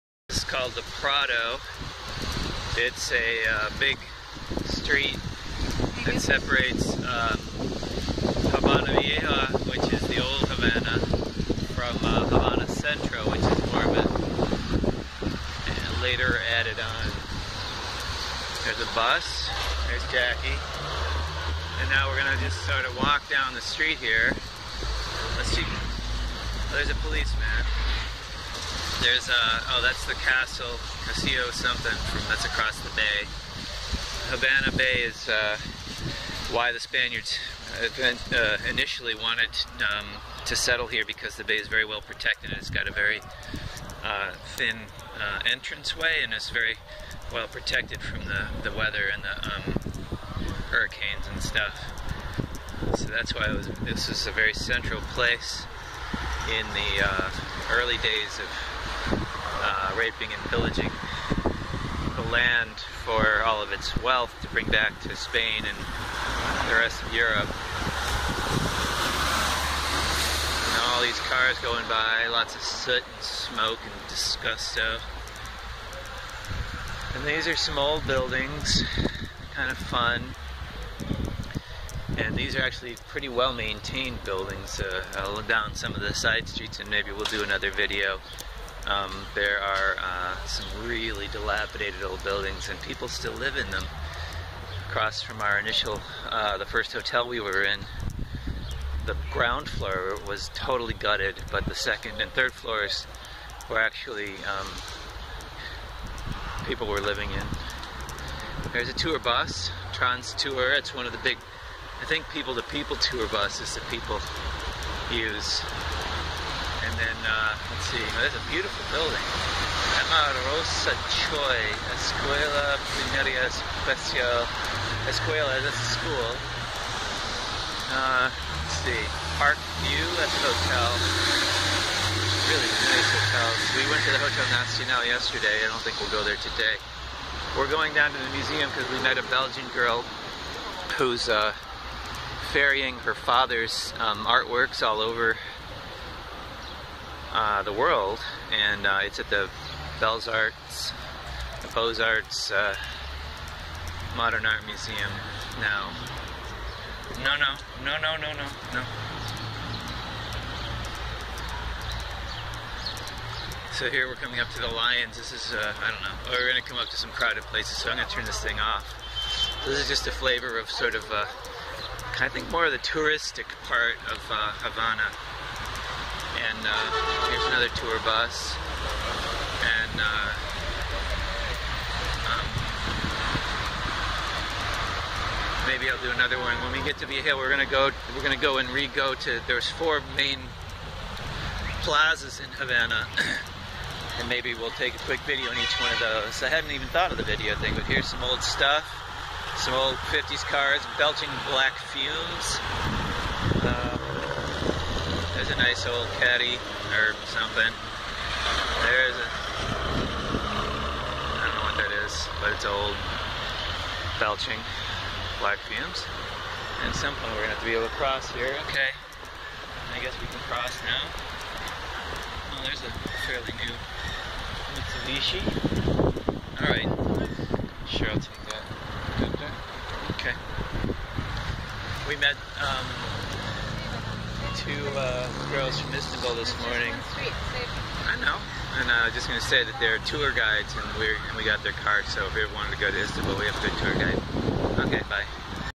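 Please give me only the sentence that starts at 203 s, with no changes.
Um, there's a nice old caddy or something.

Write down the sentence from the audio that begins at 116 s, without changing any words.
And then, uh, let's see, well, oh, that's a beautiful building.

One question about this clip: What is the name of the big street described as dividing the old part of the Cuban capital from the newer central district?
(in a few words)
the Prado.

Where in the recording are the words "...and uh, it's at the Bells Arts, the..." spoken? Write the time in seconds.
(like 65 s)
148 s.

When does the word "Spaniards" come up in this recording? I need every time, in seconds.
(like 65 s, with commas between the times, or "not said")
36 s.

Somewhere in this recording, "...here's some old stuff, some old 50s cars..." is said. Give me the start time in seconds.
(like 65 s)
197 s.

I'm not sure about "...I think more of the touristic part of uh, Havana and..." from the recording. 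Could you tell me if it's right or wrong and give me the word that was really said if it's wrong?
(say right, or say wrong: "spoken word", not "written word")
right.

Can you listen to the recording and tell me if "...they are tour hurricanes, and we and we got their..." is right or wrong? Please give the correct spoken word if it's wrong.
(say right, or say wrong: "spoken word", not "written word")
wrong: "guides", not "hurricanes".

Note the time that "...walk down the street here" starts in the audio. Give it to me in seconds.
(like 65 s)
22 s.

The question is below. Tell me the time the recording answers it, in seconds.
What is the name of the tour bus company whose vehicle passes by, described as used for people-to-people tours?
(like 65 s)
109 s.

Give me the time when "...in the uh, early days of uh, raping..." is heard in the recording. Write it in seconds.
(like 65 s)
56 s.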